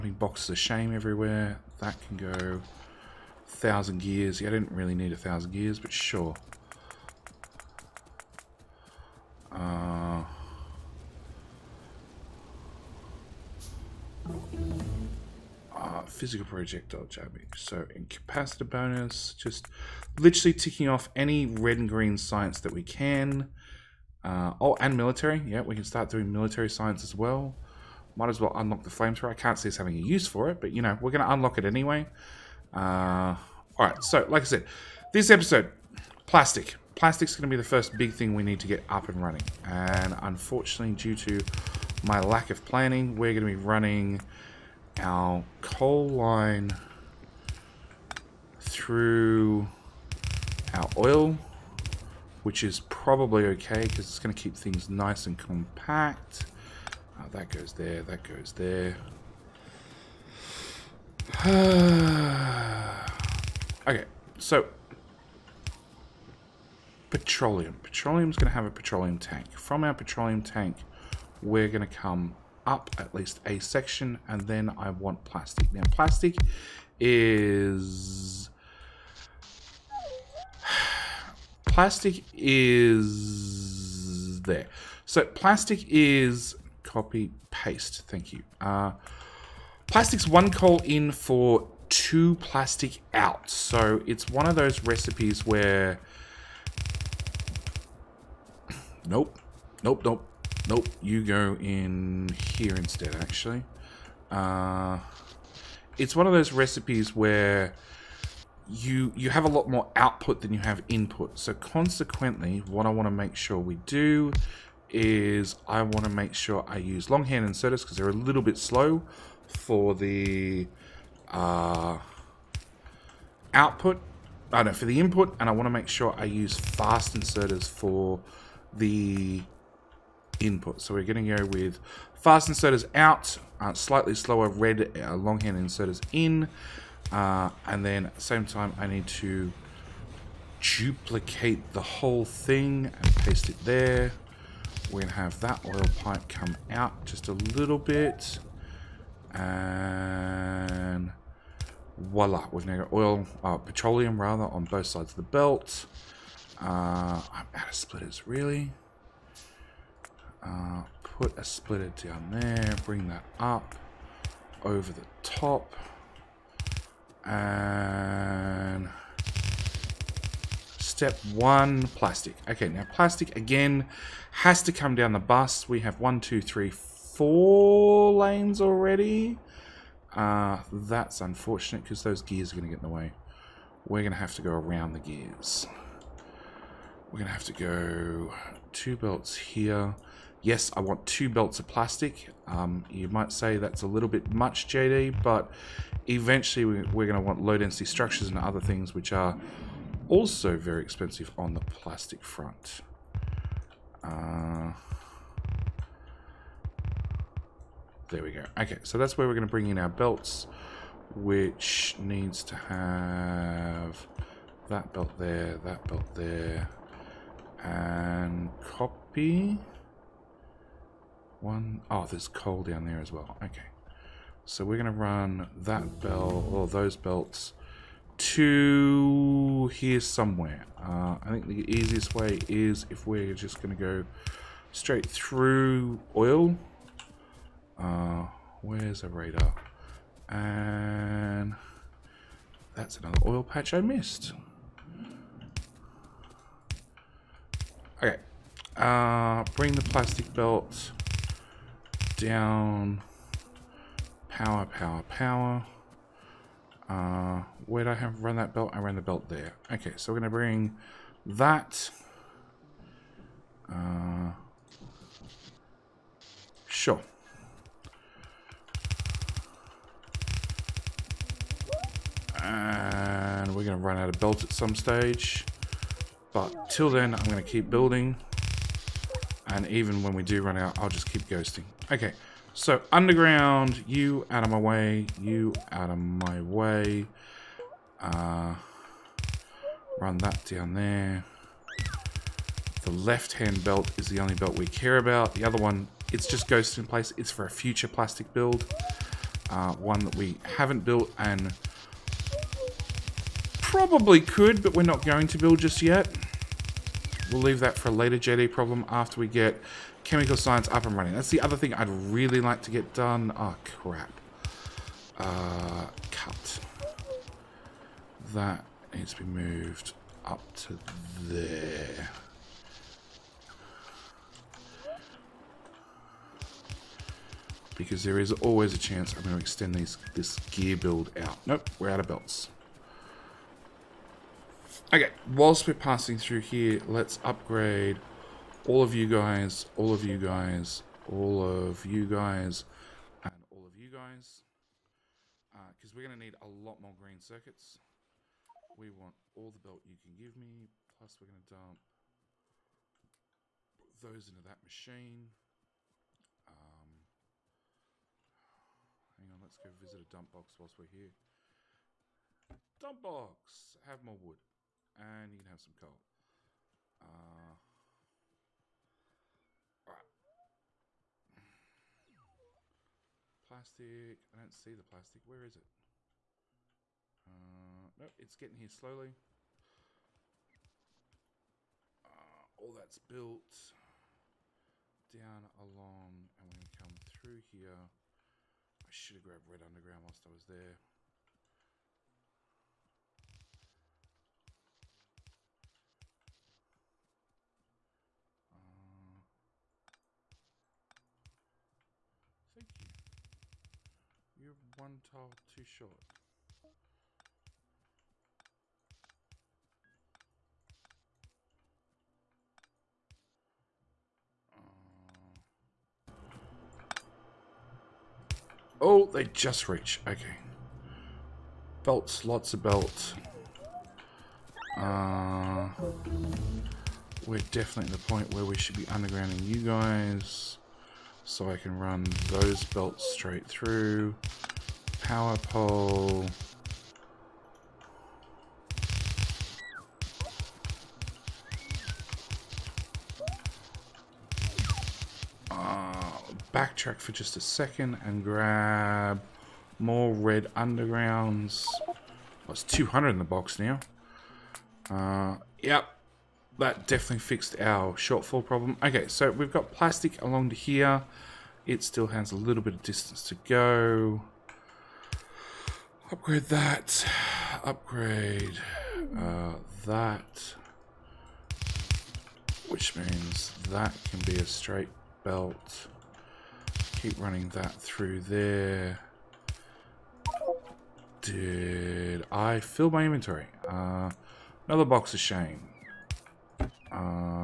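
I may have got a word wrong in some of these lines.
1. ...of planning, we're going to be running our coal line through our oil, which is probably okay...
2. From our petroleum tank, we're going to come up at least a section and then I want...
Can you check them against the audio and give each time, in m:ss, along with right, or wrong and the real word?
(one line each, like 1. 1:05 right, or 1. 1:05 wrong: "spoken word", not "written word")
1. 0:42 right
2. 1:09 right.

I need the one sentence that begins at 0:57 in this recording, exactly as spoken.
Uh, that goes there, that goes there.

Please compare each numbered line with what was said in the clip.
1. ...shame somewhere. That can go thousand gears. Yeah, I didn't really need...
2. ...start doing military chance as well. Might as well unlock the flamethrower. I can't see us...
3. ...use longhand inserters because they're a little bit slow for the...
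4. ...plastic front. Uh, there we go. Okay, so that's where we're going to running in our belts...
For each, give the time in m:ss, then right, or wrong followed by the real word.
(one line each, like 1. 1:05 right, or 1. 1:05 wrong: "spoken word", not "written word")
1. 0:00 wrong: "everywhere", not "somewhere"
2. 0:25 wrong: "science", not "chance"
3. 1:56 right
4. 3:21 wrong: "bring", not "running".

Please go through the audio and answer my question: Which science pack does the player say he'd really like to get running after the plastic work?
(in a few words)
chemical science.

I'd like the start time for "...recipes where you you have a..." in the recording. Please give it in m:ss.
1:46.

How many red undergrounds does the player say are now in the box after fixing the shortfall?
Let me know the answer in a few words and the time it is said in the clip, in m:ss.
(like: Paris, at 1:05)
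200, at 7:32.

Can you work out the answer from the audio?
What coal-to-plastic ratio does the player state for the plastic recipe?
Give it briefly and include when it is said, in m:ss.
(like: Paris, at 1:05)
1 coal for 2 plastic, at 1:30.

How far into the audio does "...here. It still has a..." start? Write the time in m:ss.
7:40.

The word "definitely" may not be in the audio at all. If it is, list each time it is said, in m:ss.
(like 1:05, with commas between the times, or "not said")
7:07, 7:36.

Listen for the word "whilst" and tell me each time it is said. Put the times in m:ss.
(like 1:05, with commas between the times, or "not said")
5:35, 6:00, 6:30.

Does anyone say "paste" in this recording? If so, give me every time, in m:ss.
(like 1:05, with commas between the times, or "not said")
1:27, 2:23.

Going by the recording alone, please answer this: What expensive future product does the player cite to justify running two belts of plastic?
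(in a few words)
low density structures.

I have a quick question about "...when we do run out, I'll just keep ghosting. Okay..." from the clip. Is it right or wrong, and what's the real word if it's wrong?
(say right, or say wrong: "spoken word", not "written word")
right.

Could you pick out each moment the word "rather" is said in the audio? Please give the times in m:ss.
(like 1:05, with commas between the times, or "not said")
2:34.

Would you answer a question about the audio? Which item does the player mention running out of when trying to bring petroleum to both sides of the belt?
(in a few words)
splitters.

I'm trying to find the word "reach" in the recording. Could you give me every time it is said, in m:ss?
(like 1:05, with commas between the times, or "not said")
6:59.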